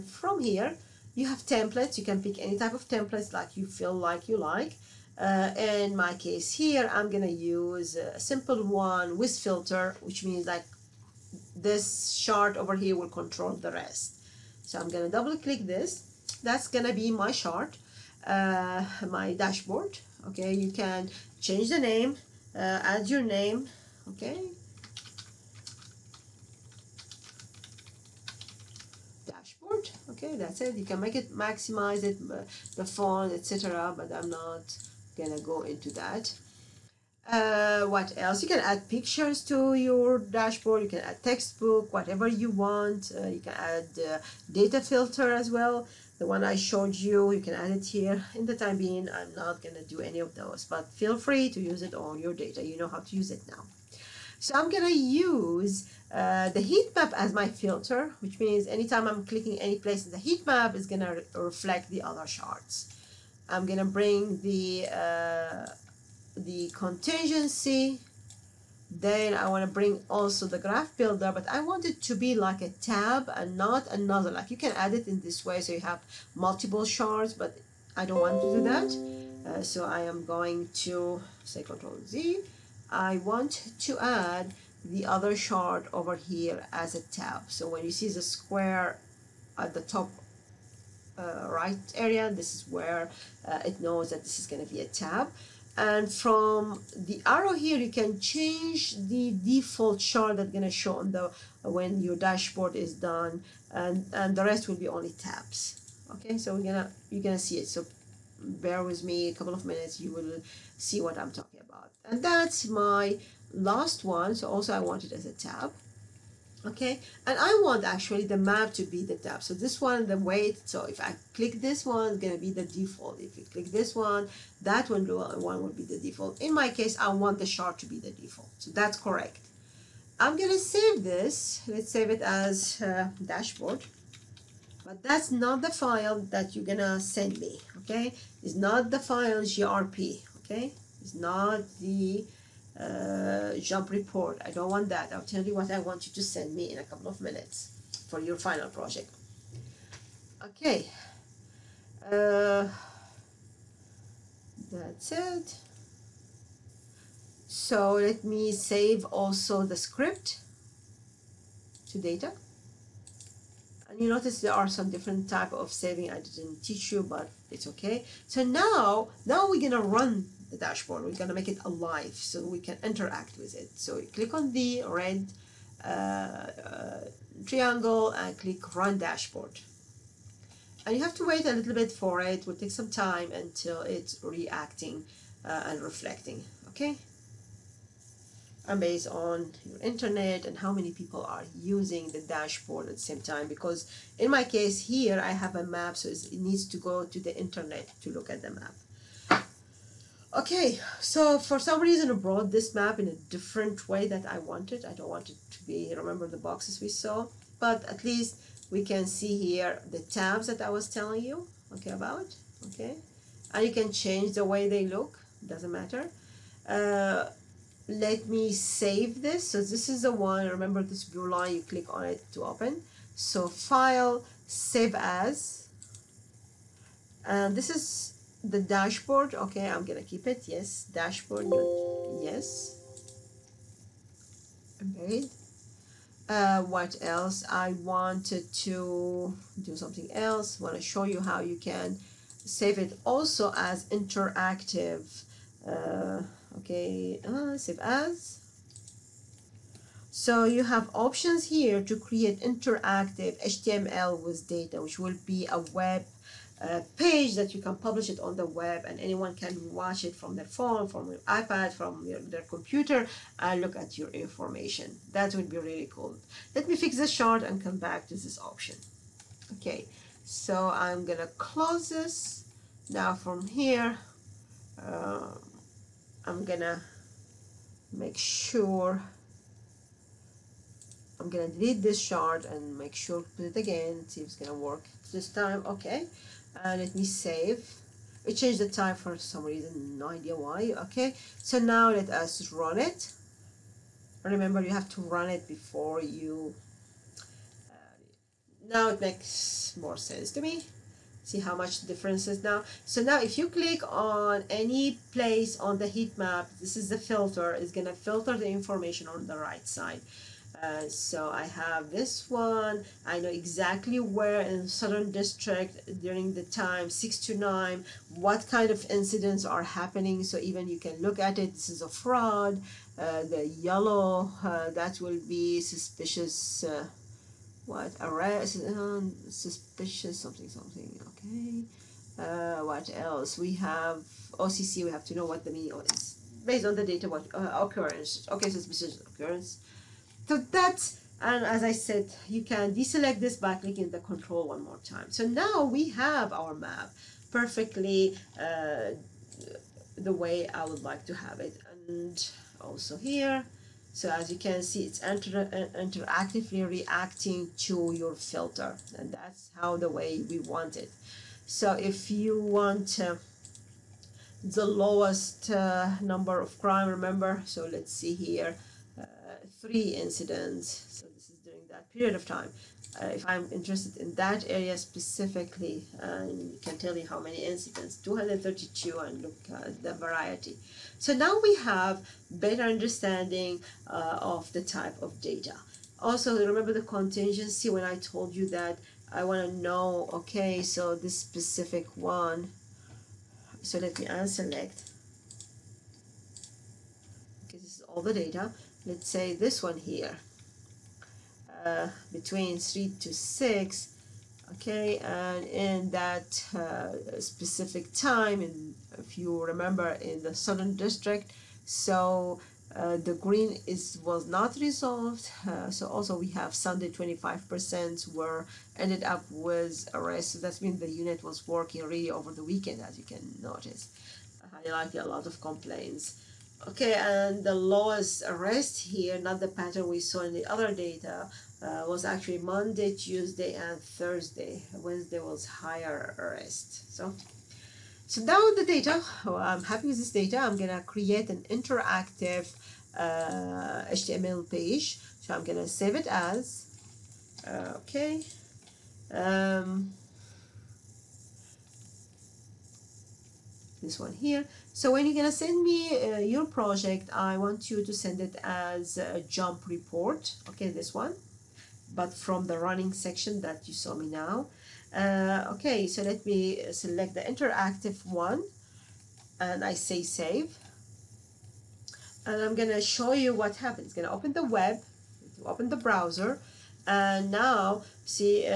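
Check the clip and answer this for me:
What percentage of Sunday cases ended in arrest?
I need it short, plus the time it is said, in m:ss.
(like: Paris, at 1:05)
25%, at 6:56.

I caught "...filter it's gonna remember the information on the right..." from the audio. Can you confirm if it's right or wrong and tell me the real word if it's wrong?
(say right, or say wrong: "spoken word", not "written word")
wrong: "filter", not "remember".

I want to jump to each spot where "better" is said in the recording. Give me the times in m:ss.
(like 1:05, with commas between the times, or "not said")
6:22.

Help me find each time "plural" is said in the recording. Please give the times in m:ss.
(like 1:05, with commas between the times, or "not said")
not said.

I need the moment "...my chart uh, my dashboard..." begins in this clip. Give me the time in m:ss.
0:17.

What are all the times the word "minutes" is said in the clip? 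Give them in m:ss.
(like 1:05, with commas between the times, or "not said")
1:49, 2:27.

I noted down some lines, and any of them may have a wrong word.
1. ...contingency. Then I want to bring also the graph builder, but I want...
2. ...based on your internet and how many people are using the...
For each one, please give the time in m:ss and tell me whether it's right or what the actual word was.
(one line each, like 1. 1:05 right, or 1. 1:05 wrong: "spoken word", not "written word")
1. 1:06 right
2. 3:08 right.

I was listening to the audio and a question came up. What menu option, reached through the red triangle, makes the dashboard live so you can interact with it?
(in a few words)
Run Dashboard.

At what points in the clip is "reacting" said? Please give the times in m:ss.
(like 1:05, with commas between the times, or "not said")
3:04, 5:56.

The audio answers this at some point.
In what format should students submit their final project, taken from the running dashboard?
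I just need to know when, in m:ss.
7:39.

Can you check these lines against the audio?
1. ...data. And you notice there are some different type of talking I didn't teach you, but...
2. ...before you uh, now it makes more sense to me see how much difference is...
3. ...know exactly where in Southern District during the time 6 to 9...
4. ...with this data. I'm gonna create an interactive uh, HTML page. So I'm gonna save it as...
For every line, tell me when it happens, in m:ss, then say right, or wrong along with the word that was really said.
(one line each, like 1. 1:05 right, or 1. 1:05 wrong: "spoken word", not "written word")
1. 2:41 wrong: "saving", not "talking"
2. 4:55 right
3. 5:13 right
4. 7:19 right.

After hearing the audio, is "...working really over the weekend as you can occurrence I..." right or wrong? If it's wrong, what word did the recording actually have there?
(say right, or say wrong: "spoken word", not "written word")
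wrong: "notice", not "occurrence".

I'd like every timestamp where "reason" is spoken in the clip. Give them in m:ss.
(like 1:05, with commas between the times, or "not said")
3:21, 4:49.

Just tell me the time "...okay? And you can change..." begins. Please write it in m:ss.
3:32.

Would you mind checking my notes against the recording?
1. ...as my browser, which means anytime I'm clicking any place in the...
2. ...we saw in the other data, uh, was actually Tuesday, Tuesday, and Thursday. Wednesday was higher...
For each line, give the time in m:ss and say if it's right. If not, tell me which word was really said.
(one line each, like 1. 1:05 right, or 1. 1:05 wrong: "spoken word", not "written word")
1. 0:57 wrong: "filter", not "browser"
2. 7:09 wrong: "Monday", not "Tuesday".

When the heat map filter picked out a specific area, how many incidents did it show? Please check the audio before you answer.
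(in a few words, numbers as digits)
232.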